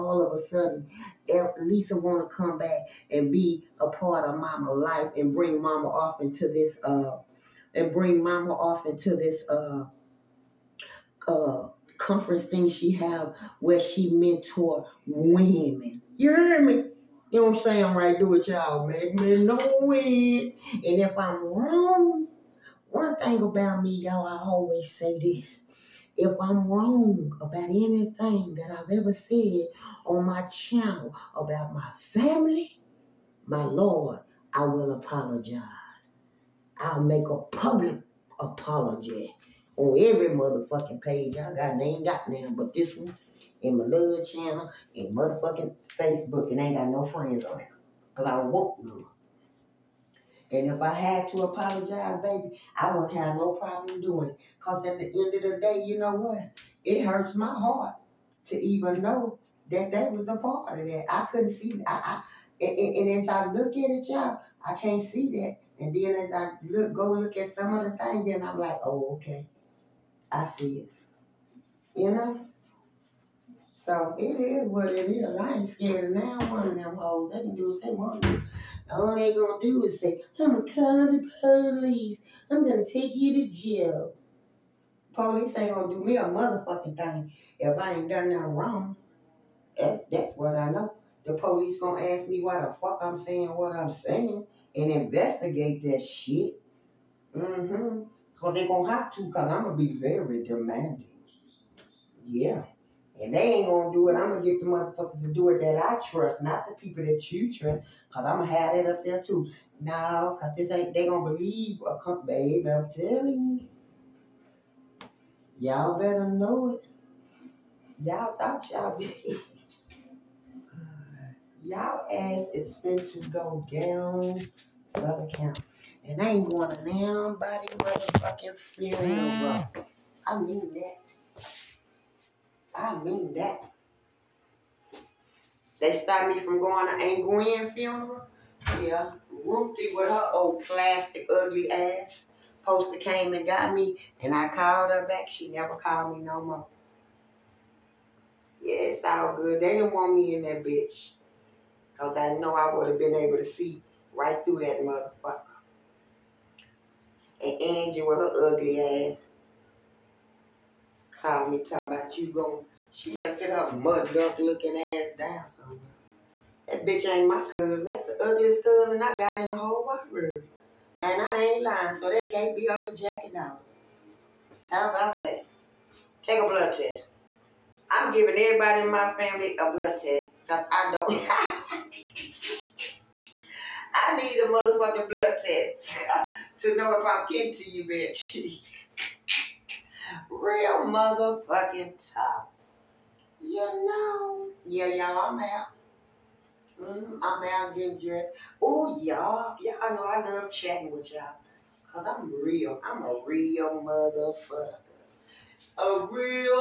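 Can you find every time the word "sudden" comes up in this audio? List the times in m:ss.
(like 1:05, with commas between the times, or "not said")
0:00.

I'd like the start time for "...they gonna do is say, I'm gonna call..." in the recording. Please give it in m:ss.
1:19.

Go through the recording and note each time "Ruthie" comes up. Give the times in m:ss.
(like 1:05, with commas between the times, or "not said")
2:19.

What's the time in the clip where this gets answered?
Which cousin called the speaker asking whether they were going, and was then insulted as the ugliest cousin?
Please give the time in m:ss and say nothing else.
2:37.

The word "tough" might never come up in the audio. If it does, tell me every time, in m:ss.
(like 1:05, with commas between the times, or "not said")
3:12.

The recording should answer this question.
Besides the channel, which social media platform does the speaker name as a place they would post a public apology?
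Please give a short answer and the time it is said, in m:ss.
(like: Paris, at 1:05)
Facebook, at 0:45.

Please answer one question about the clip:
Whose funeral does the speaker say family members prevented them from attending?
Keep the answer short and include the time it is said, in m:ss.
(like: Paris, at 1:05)
Aunt Gwen, at 2:17.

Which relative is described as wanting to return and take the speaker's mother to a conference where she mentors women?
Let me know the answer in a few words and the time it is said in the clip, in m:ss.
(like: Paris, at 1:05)
Lisa, at 0:01.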